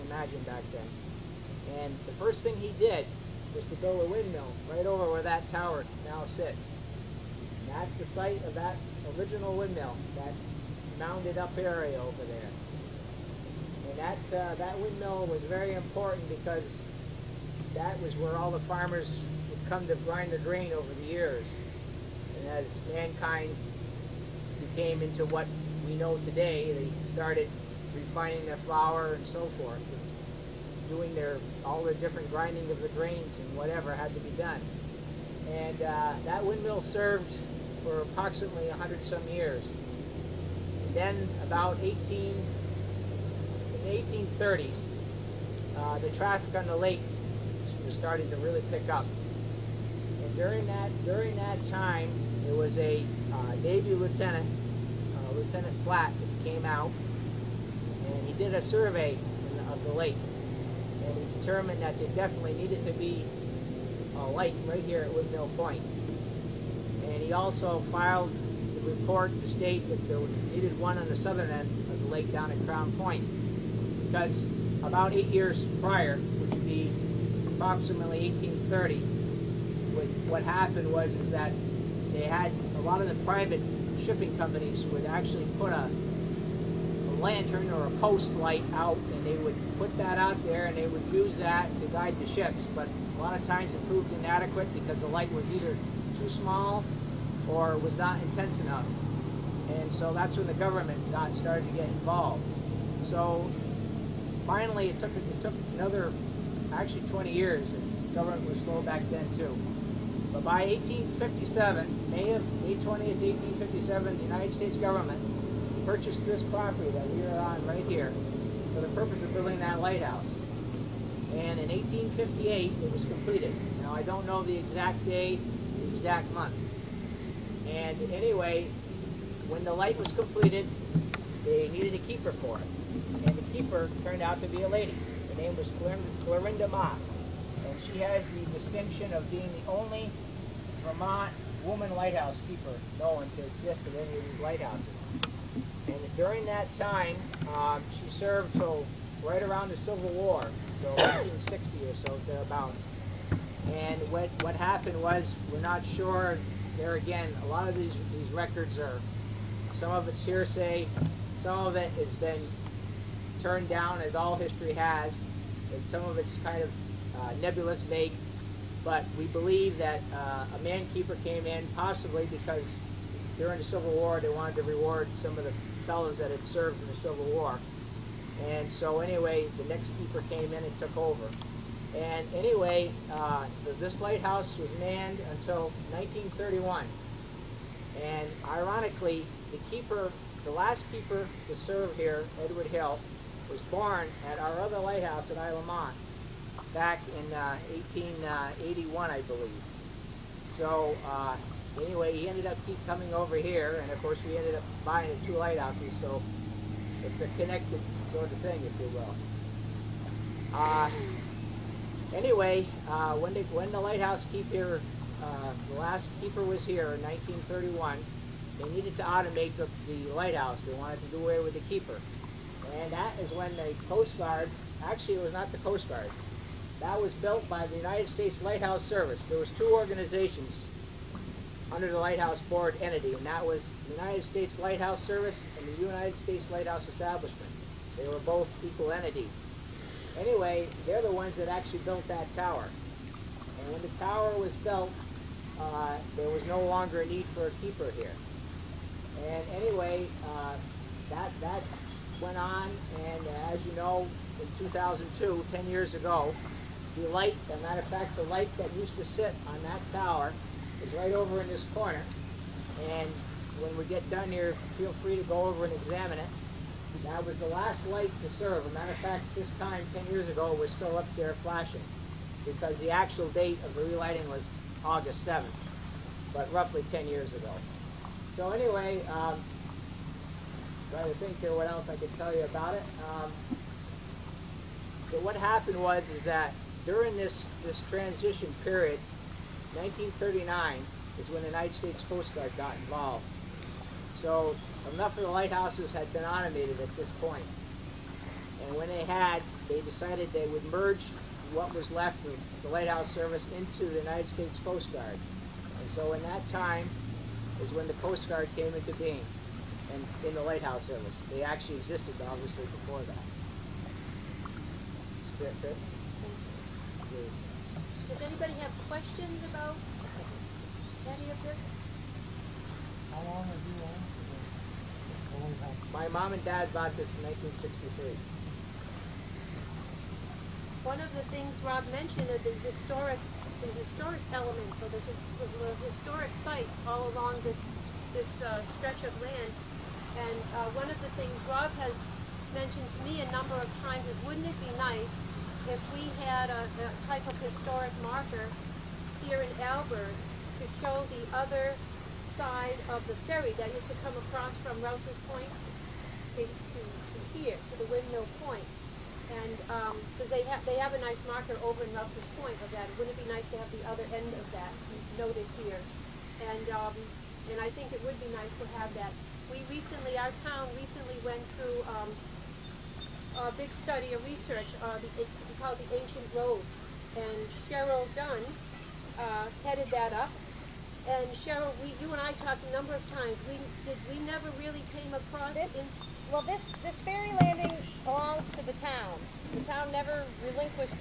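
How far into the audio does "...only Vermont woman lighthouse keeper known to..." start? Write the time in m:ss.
2:19.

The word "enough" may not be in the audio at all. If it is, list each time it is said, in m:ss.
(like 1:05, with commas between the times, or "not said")
1:38, 4:54.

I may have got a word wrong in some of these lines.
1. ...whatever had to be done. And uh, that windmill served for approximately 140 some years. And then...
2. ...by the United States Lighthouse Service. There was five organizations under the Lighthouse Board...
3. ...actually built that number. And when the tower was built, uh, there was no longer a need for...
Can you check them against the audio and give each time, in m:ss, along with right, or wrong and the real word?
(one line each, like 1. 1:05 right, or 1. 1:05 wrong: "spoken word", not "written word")
1. 0:33 wrong: "100", not "140"
2. 3:47 wrong: "two", not "five"
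3. 4:01 wrong: "tower", not "number".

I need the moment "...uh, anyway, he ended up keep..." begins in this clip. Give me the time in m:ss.
3:21.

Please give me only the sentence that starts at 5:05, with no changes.
And so in that time is when the Coast Guard came into being and in the lighthouse service.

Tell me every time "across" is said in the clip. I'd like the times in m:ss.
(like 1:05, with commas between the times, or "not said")
5:54, 6:25.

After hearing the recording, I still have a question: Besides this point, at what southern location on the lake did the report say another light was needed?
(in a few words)
Crown Point.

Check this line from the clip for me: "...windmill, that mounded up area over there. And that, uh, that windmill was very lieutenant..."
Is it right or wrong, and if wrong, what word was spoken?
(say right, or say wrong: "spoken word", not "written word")
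wrong: "important", not "lieutenant".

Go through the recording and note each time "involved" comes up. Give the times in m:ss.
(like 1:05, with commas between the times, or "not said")
1:41, 4:52.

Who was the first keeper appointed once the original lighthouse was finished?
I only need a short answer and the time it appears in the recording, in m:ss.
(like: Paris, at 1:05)
Clorinda Mott, at 2:16.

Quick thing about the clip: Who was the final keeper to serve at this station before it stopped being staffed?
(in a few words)
Edward Hill.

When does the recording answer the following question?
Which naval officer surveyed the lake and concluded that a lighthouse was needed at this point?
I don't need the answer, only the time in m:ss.
0:55.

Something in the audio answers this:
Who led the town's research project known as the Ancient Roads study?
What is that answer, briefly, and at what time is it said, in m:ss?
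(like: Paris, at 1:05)
Cheryl Dunn, at 6:17.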